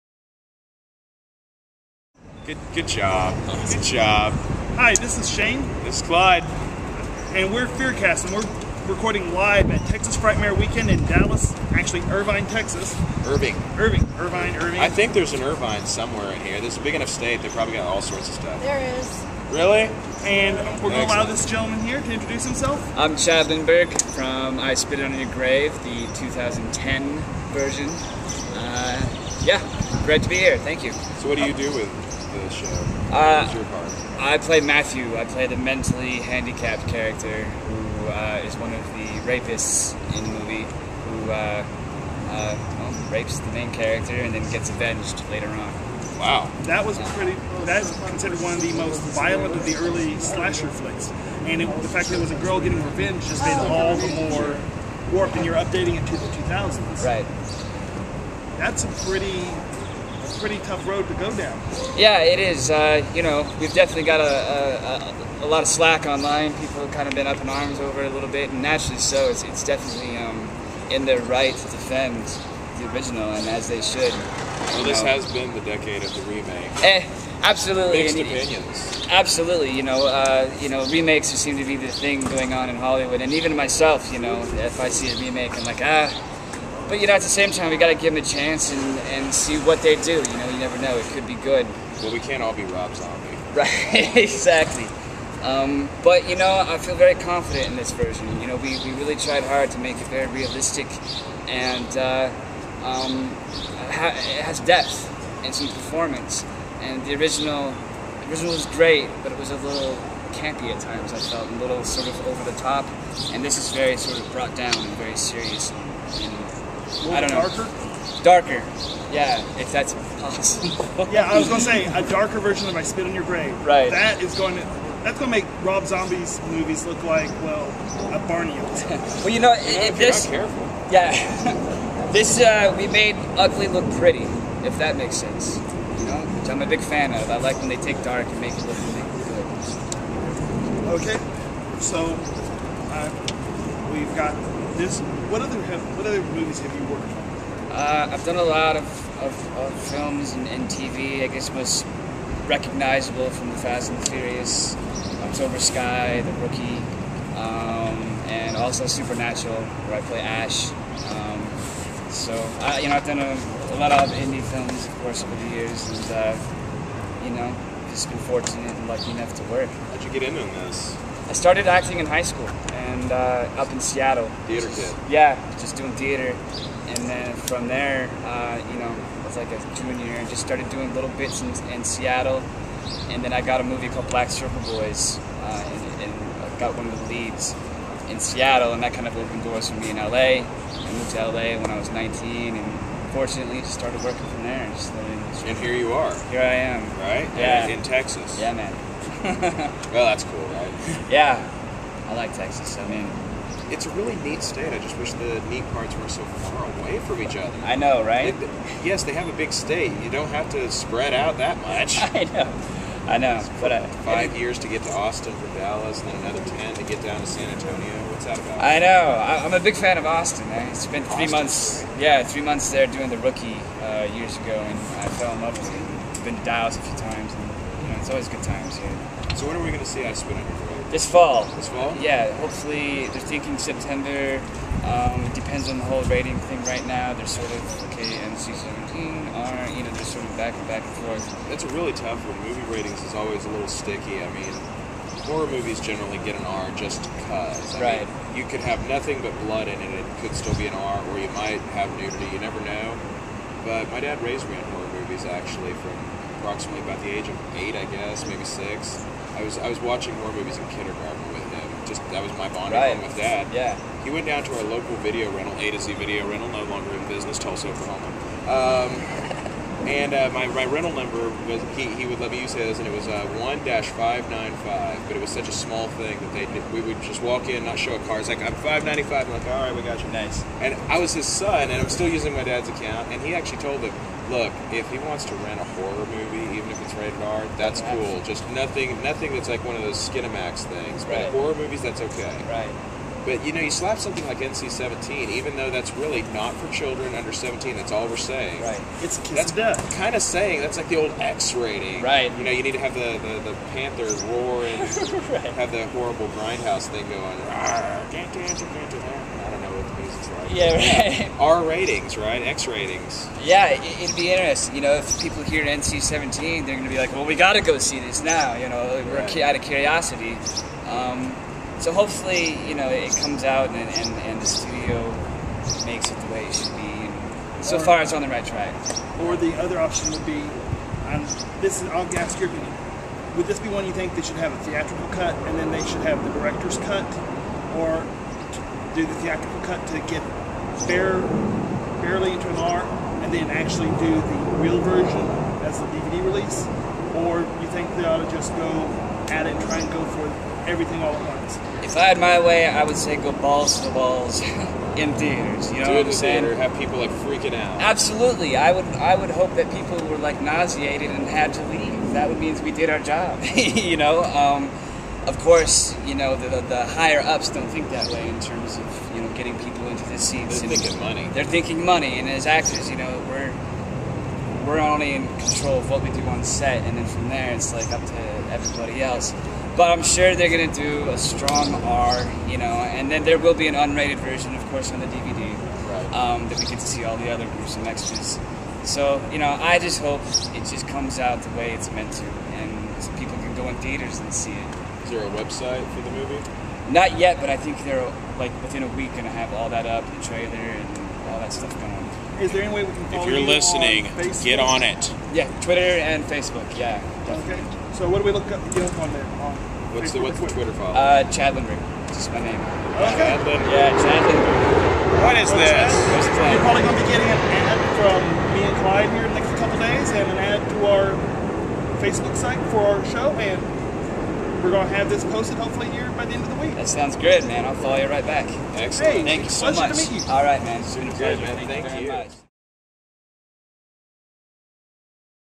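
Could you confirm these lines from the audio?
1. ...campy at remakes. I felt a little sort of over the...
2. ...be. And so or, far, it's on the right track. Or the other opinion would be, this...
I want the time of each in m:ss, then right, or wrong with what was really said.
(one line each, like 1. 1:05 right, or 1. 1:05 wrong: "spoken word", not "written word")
1. 1:50 wrong: "times", not "remakes"
2. 5:26 wrong: "option", not "opinion".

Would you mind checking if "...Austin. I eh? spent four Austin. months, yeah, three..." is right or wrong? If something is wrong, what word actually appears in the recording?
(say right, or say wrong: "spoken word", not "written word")
wrong: "three", not "four".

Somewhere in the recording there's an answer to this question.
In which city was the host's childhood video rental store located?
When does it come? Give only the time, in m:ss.
4:27.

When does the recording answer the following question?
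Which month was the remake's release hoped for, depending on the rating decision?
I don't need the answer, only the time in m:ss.
3:53.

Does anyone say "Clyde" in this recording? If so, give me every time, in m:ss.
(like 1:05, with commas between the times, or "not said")
0:06, 6:58.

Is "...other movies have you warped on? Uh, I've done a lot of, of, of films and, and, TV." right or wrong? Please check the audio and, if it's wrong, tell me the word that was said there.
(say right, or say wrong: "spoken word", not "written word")
wrong: "worked", not "warped".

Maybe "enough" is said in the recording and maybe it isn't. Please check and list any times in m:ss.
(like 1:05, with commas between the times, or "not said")
0:16, 2:49.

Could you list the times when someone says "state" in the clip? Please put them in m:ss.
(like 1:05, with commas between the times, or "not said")
0:17, 3:24, 3:29.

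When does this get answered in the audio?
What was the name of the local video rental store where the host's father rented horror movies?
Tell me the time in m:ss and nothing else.
4:25.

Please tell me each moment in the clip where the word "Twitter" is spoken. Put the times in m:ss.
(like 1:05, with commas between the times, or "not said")
6:45, 6:50.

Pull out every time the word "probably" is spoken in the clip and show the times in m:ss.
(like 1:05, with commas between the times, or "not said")
0:17, 6:56.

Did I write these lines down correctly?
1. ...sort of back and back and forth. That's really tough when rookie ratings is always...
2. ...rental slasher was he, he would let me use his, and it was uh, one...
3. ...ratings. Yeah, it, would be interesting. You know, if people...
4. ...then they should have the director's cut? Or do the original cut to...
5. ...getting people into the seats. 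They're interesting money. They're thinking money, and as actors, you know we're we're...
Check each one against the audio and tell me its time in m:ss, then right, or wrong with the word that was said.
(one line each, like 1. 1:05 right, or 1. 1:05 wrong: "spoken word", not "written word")
1. 4:00 wrong: "movie", not "rookie"
2. 4:30 wrong: "number", not "slasher"
3. 5:12 right
4. 5:35 wrong: "theatrical", not "original"
5. 6:09 wrong: "thinking", not "interesting".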